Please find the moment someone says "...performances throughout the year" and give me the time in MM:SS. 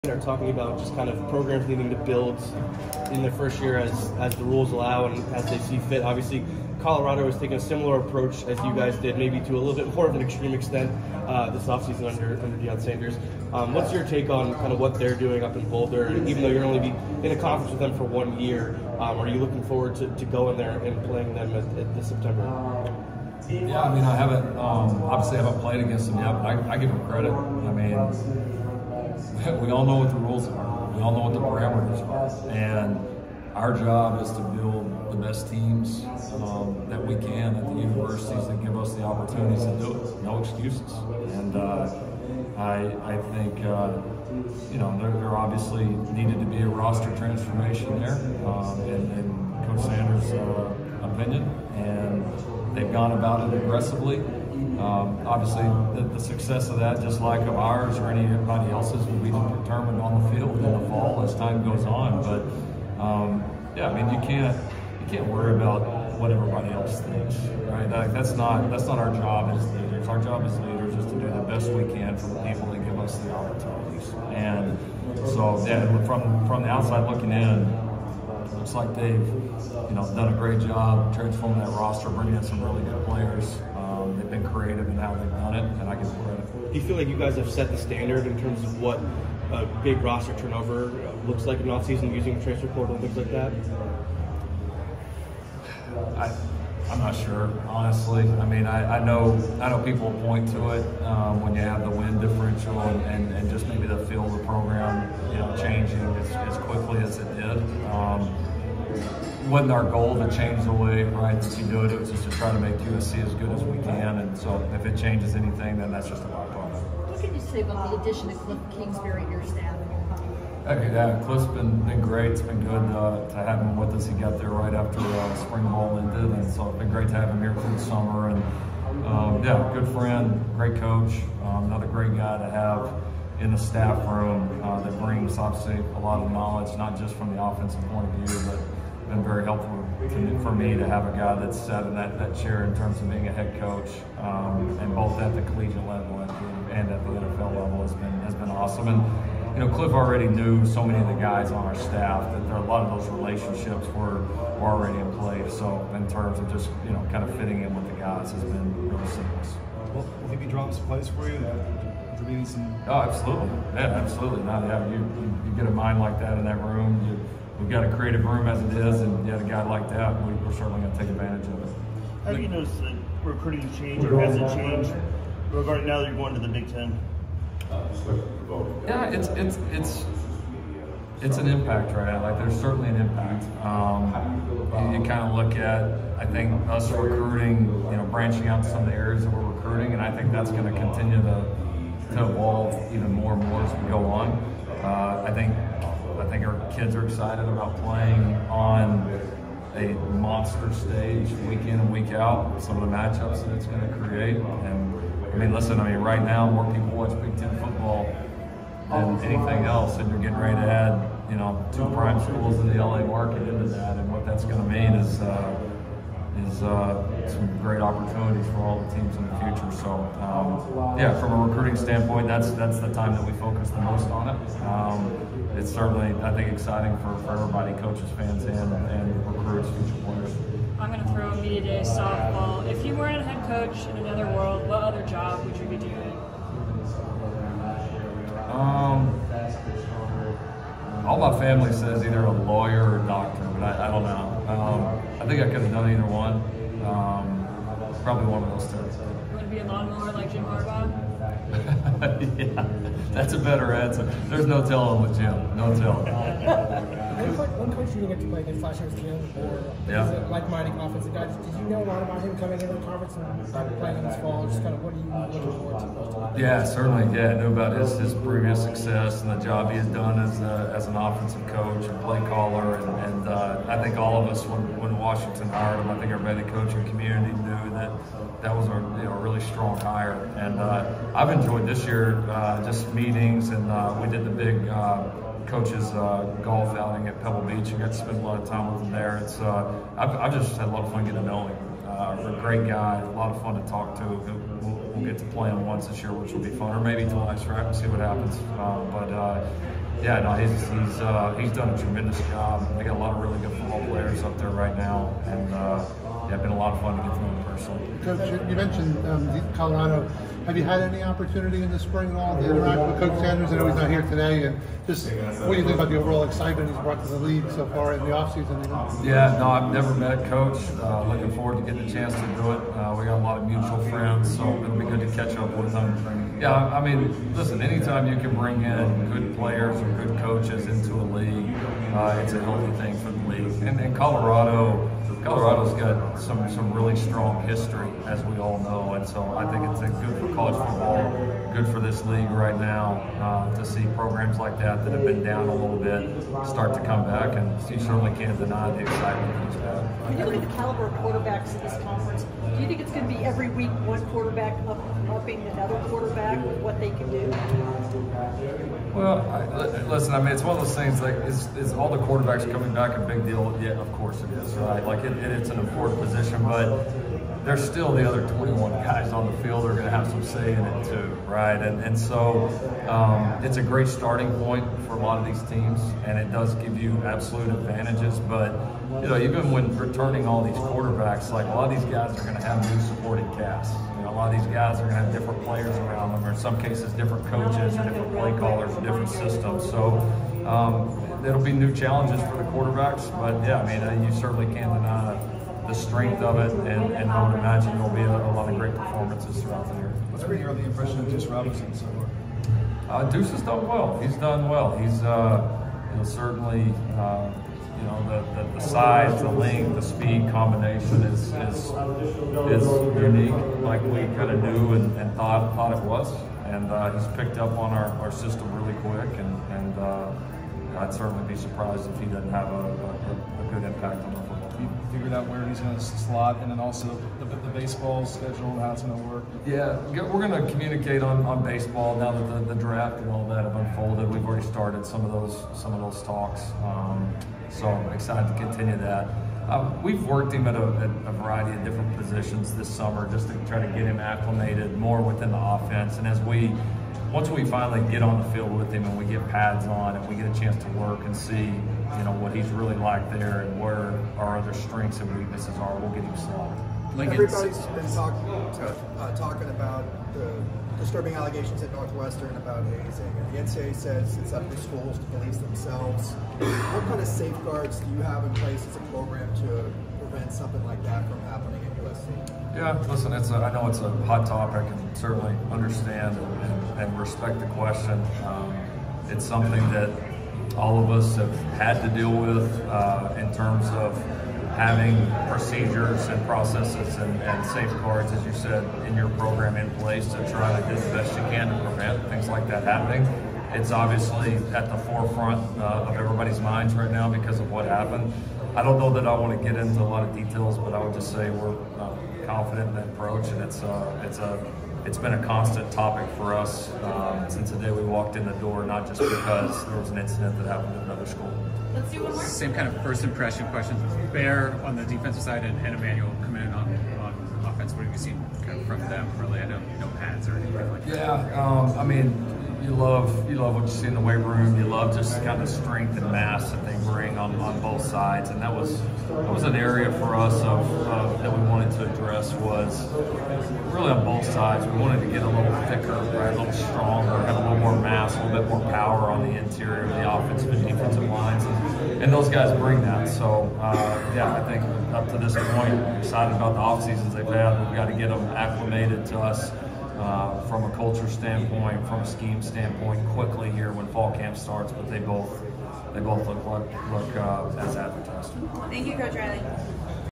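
06:38.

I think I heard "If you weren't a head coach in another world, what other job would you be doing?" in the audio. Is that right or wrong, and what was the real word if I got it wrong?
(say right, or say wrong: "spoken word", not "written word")
right.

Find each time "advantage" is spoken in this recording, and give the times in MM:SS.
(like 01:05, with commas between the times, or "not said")
02:51, 06:17.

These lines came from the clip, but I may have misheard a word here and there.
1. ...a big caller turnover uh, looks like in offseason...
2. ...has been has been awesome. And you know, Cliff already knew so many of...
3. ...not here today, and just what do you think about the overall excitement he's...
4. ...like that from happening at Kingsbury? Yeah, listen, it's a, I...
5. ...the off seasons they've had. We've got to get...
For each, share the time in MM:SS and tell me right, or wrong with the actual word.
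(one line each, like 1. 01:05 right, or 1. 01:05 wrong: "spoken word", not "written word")
1. 01:29 wrong: "roster", not "caller"
2. 02:27 right
3. 05:13 right
4. 07:50 wrong: "USC", not "Kingsbury"
5. 09:06 right.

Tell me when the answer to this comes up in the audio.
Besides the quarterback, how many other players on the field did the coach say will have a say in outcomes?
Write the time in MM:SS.
06:08.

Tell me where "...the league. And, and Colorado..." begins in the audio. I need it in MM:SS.
05:33.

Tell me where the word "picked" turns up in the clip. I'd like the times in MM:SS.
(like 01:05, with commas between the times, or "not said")
06:57.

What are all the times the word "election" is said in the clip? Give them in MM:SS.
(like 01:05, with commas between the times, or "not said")
not said.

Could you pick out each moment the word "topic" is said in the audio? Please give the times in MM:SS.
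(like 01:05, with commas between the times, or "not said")
07:54, 08:25.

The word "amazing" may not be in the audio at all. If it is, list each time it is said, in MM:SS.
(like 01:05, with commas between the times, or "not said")
not said.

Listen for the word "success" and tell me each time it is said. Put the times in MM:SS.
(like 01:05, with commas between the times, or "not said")
00:56, 04:28.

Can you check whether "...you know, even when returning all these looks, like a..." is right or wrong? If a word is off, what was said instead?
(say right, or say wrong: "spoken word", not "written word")
wrong: "quarterbacks", not "looks".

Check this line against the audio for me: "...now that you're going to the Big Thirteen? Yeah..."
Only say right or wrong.
wrong.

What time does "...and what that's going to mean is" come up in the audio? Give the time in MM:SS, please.
03:33.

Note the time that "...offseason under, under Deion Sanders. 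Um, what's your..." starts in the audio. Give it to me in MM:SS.
00:11.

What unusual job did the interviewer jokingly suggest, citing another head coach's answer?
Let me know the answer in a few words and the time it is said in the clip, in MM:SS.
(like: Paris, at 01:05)
lawnmower, at 04:09.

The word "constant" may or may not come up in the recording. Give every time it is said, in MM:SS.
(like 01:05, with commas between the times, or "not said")
08:25.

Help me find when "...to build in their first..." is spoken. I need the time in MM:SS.
00:01.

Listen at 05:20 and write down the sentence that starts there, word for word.
Uh, looking forward to getting a chance to do it.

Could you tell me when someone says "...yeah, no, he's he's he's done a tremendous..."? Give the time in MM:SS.
05:00.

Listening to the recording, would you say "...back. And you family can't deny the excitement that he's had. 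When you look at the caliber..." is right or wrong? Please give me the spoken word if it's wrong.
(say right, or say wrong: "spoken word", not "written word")
wrong: "certainly", not "family".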